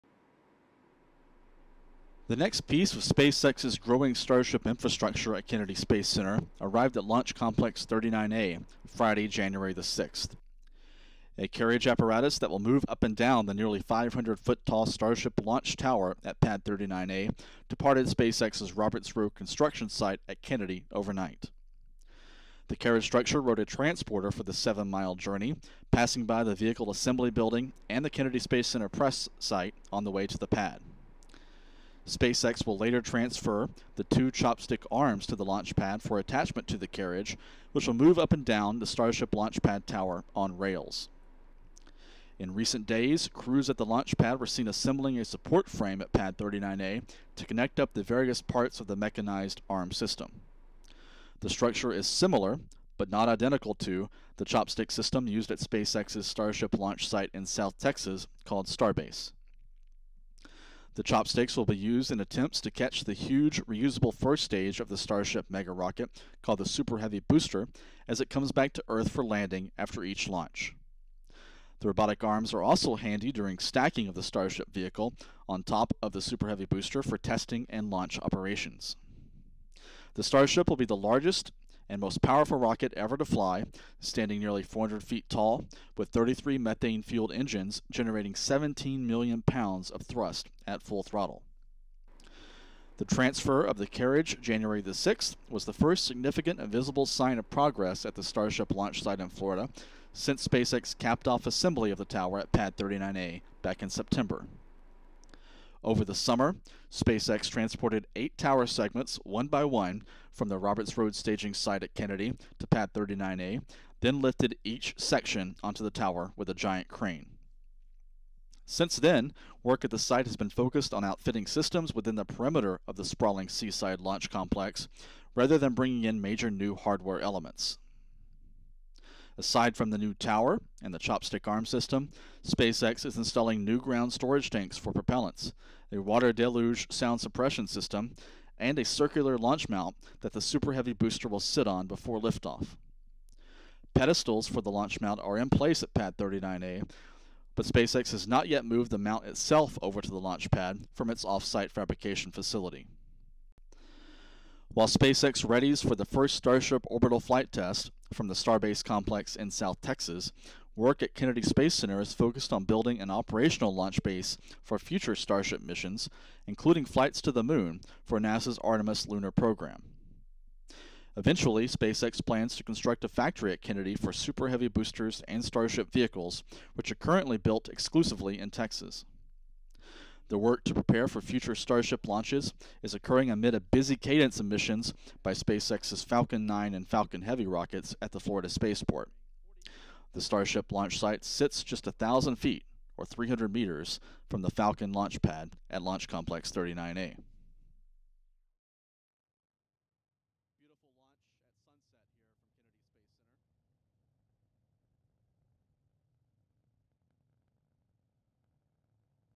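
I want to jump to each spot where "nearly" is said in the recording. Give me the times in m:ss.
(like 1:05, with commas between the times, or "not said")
0:13, 1:24.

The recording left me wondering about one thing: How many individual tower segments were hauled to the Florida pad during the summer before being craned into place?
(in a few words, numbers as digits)
8.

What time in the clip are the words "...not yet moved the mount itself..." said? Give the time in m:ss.
2:28.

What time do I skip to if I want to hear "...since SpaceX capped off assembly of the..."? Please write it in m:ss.
1:40.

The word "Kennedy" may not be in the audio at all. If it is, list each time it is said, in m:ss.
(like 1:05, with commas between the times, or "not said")
0:05, 0:20, 0:28, 1:51, 2:41, 2:53.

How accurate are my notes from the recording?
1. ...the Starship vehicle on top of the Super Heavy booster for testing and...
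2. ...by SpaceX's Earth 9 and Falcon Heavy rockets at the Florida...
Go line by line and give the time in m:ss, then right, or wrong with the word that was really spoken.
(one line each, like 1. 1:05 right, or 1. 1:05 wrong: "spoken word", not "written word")
1. 1:14 right
2. 3:05 wrong: "Falcon", not "Earth".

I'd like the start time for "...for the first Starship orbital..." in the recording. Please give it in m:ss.
2:35.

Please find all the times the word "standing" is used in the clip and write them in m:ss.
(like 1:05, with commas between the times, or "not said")
1:23.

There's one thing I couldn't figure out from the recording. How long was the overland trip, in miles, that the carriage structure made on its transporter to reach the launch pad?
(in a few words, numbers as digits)
7 miles.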